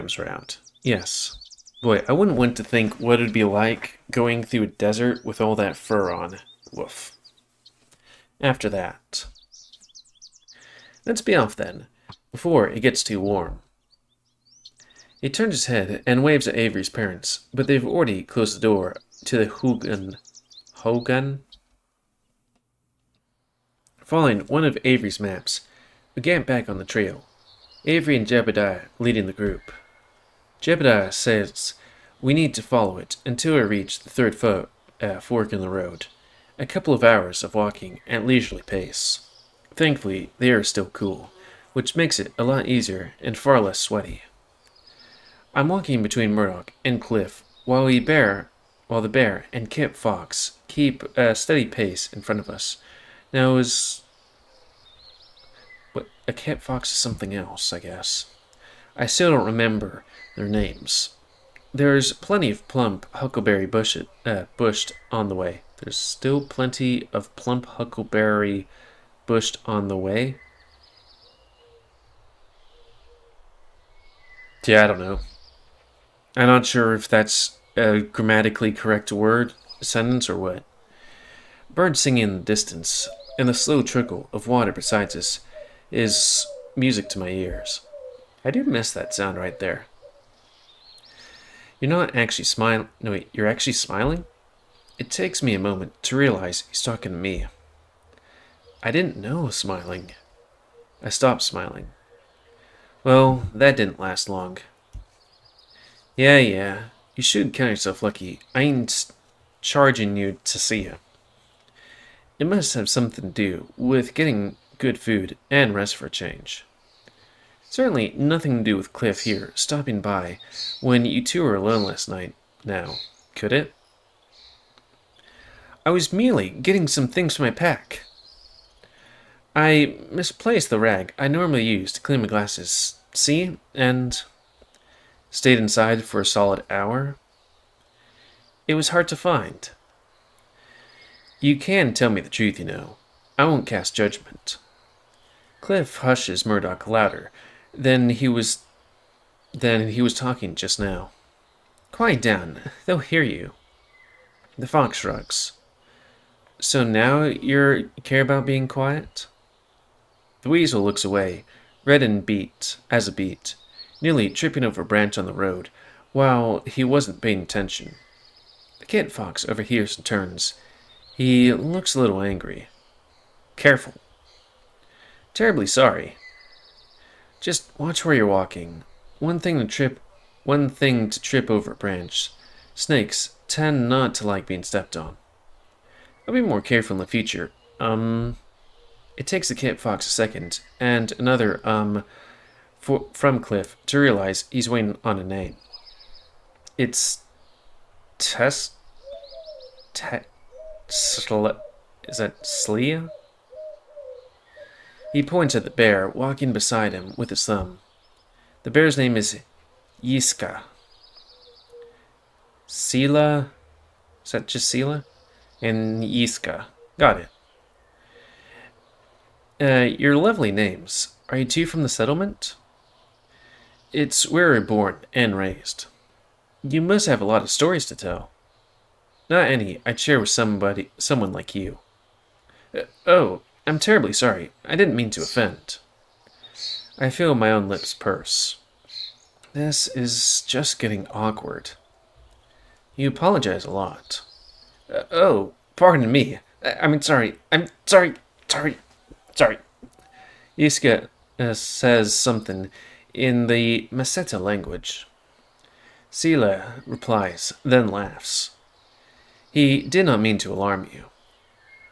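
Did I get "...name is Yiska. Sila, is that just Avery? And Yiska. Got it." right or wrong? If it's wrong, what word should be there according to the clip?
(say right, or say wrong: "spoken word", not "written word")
wrong: "Sila", not "Avery".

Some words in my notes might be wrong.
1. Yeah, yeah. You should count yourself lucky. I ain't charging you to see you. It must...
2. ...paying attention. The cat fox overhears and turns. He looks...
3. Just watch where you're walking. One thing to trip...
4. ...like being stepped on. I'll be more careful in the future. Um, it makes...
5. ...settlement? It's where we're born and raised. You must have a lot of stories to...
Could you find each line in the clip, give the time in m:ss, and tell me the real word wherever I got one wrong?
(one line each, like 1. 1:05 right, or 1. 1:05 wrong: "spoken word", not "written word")
1. 1:46 right
2. 2:47 right
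3. 2:57 right
4. 3:04 wrong: "takes", not "makes"
5. 3:41 right.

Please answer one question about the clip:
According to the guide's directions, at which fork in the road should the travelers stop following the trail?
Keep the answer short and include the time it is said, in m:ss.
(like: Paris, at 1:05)
third, at 0:34.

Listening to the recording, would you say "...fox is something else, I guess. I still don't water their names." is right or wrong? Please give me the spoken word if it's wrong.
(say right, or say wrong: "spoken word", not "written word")
wrong: "remember", not "water".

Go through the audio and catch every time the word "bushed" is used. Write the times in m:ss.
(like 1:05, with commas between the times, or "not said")
1:04, 1:09.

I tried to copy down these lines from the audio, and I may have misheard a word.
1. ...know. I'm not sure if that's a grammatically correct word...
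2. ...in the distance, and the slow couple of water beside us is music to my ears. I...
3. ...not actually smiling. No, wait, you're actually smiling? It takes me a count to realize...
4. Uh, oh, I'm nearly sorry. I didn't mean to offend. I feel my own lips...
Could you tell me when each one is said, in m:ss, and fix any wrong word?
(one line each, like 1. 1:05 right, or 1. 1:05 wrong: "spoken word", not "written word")
1. 1:14 right
2. 1:22 wrong: "trickle", not "couple"
3. 1:31 wrong: "moment", not "count"
4. 3:52 wrong: "terribly", not "nearly".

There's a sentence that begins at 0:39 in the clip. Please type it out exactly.
Thankfully, they are still cool, which makes it a lot easier and far less sweaty.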